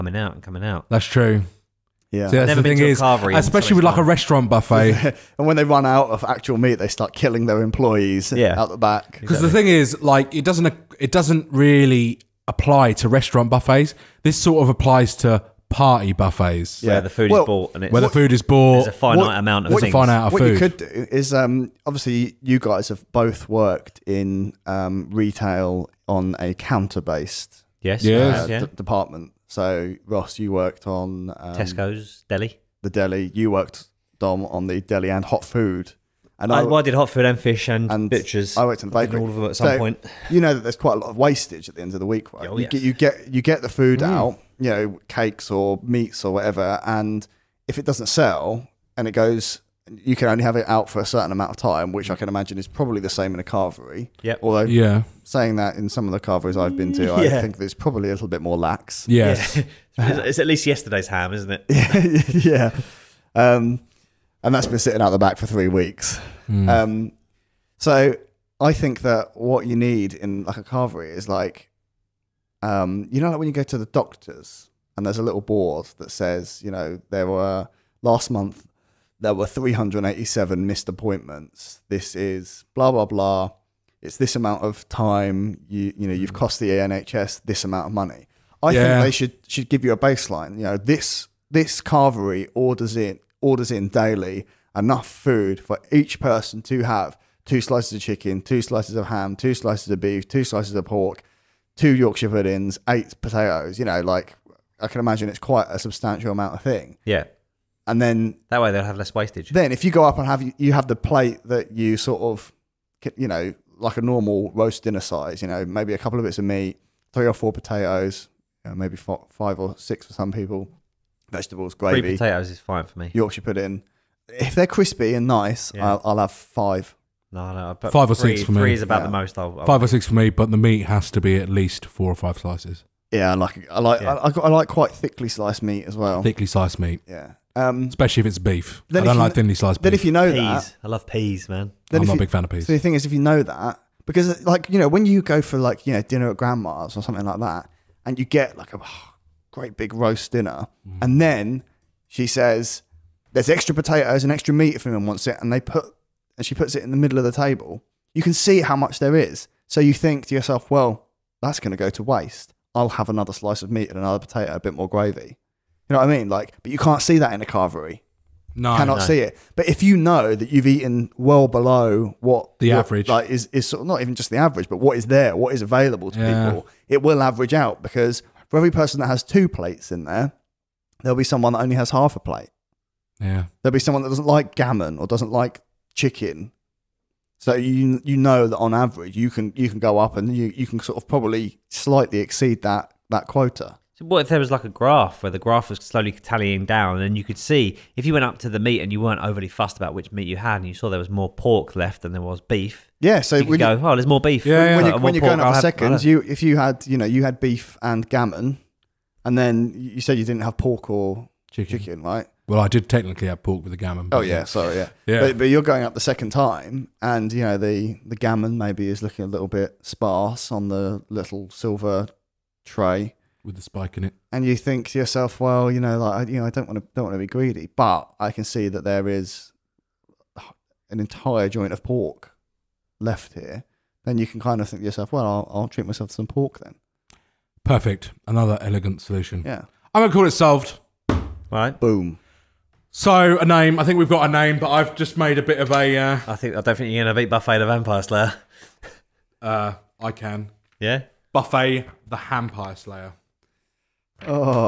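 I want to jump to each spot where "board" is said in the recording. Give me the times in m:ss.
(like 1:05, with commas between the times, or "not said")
1:15.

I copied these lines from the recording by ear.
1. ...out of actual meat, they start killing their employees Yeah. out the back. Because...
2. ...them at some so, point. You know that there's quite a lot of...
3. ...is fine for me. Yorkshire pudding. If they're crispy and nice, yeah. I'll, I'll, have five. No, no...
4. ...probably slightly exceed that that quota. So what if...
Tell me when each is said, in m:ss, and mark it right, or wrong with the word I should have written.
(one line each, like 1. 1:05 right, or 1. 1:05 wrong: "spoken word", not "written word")
1. 0:05 right
2. 0:39 right
3. 2:02 right
4. 3:11 right.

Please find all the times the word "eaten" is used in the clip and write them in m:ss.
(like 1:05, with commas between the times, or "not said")
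2:50.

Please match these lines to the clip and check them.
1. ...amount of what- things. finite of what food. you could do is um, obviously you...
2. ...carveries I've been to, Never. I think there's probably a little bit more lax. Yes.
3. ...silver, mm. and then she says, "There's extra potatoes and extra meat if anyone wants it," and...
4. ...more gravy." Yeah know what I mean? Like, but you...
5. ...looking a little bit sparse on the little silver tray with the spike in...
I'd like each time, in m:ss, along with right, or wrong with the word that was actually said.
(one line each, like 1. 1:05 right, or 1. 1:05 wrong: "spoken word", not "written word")
1. 0:19 right
2. 0:56 wrong: "Yeah", not "Never"
3. 2:30 wrong: "dinner", not "silver"
4. 2:44 wrong: "You", not "Yeah"
5. 3:39 right.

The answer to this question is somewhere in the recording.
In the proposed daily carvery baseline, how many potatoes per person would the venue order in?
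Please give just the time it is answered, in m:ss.
1:42.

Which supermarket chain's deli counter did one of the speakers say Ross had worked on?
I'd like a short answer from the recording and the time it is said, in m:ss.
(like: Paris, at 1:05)
Tesco, at 0:31.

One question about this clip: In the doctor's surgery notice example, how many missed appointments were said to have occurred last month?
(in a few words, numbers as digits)
387.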